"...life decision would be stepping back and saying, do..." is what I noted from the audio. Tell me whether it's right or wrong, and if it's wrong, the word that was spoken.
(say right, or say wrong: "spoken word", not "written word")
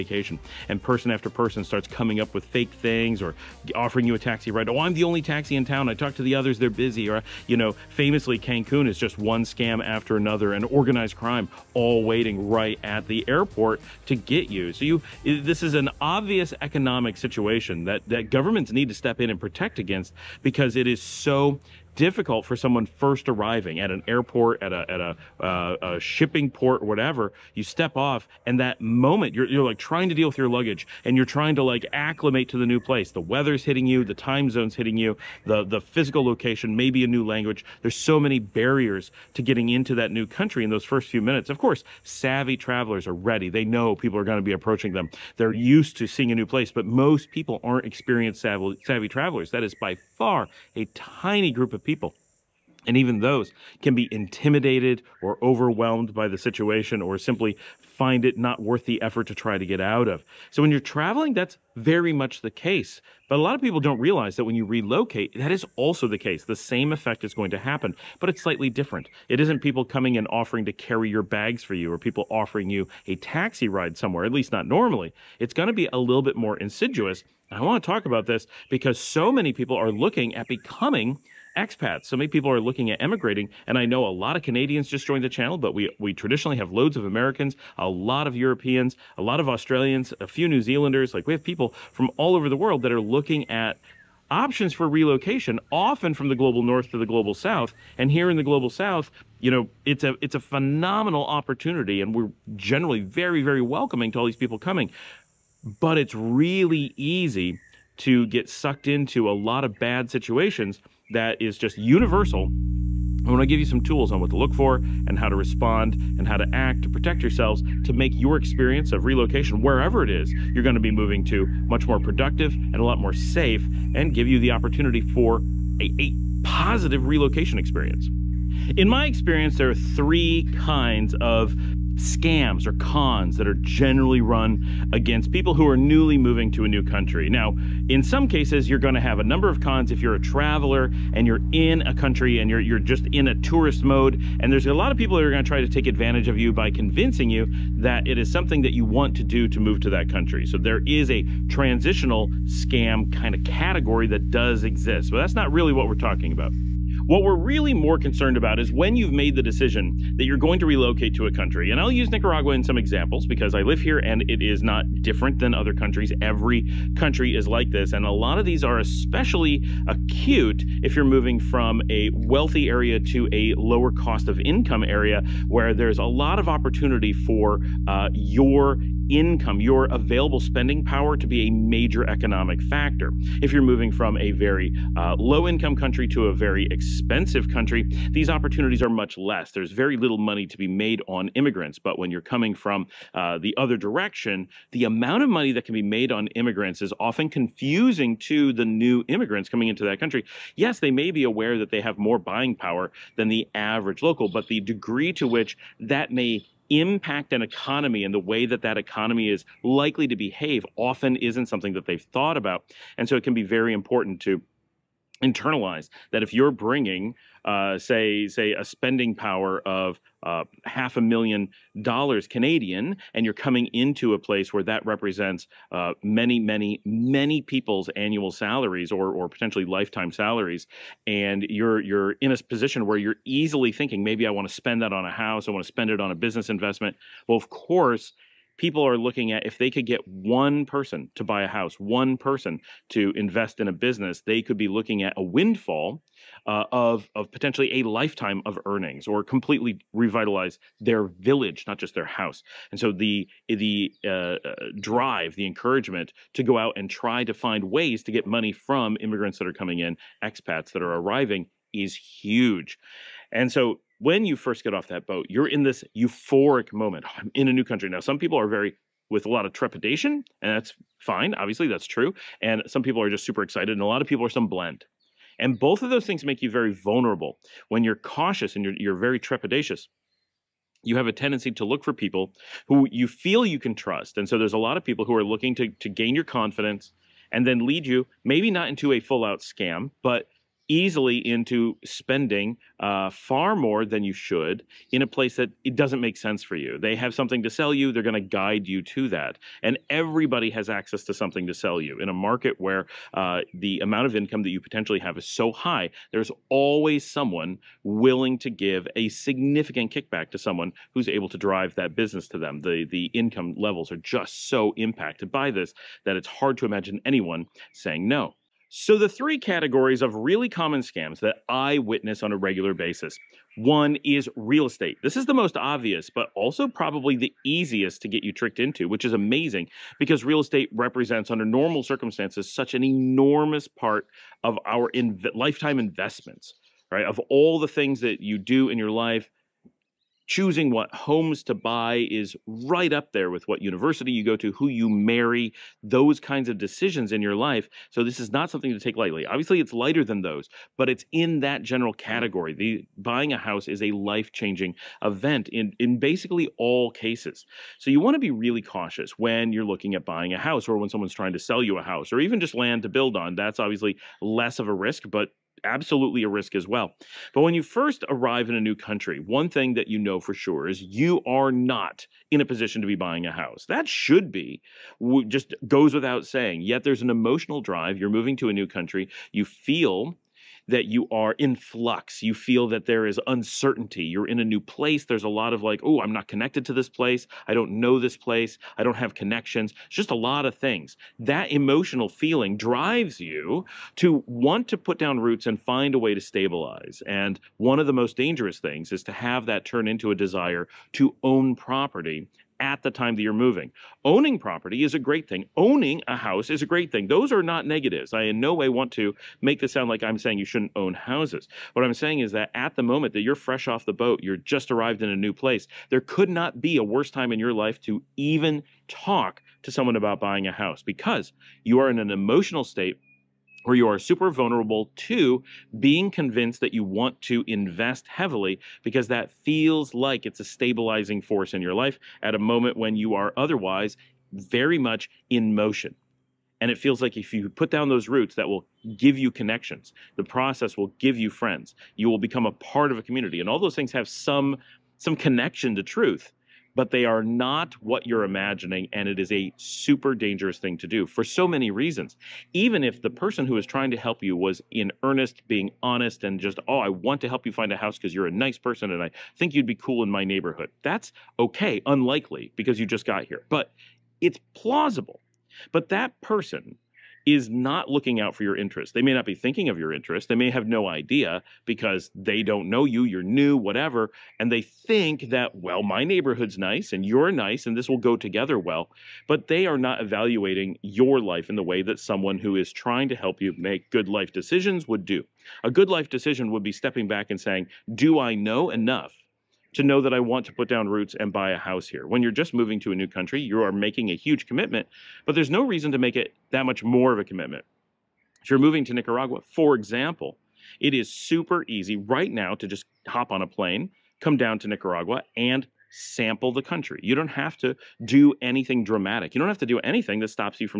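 right.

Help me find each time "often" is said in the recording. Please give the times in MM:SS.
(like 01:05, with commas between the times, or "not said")
01:35, 03:17, 03:30.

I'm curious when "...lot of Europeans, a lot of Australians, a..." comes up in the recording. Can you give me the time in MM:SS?
01:27.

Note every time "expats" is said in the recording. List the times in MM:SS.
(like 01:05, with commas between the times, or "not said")
01:21, 04:20.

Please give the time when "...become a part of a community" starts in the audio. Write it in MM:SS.
07:22.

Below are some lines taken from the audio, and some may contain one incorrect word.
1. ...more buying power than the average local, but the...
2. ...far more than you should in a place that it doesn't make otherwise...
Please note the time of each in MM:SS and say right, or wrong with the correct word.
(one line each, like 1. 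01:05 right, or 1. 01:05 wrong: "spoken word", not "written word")
1. 03:21 right
2. 04:53 wrong: "sense", not "otherwise".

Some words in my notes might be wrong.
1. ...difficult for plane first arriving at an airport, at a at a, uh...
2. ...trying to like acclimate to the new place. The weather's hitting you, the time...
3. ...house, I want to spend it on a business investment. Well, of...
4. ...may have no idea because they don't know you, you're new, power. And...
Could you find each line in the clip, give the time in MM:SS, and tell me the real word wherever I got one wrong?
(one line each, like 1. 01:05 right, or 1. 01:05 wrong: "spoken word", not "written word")
1. 00:21 wrong: "someone", not "plane"
2. 00:31 right
3. 03:55 right
4. 07:50 wrong: "whatever", not "power".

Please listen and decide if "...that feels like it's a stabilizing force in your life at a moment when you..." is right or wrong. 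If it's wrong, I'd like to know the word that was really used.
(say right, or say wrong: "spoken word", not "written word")
right.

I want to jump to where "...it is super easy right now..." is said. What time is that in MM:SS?
08:20.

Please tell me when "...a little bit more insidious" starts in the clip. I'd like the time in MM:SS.
01:15.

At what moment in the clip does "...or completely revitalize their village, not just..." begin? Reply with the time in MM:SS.
04:09.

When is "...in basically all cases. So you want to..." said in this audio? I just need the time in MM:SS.
05:55.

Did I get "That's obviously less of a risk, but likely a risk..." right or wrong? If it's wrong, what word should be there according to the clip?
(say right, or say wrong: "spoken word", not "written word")
wrong: "absolutely", not "likely".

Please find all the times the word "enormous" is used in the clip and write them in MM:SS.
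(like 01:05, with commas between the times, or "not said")
05:32.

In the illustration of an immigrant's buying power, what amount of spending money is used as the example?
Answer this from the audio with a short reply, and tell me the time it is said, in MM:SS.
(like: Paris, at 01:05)
half a million dollars Canadian, at 03:40.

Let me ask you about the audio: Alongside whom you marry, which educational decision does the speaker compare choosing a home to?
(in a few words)
what university you go to.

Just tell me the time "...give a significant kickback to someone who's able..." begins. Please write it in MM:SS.
05:08.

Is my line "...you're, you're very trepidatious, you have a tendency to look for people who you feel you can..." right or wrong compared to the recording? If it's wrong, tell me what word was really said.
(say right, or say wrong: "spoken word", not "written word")
right.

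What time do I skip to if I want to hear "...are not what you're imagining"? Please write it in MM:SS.
07:27.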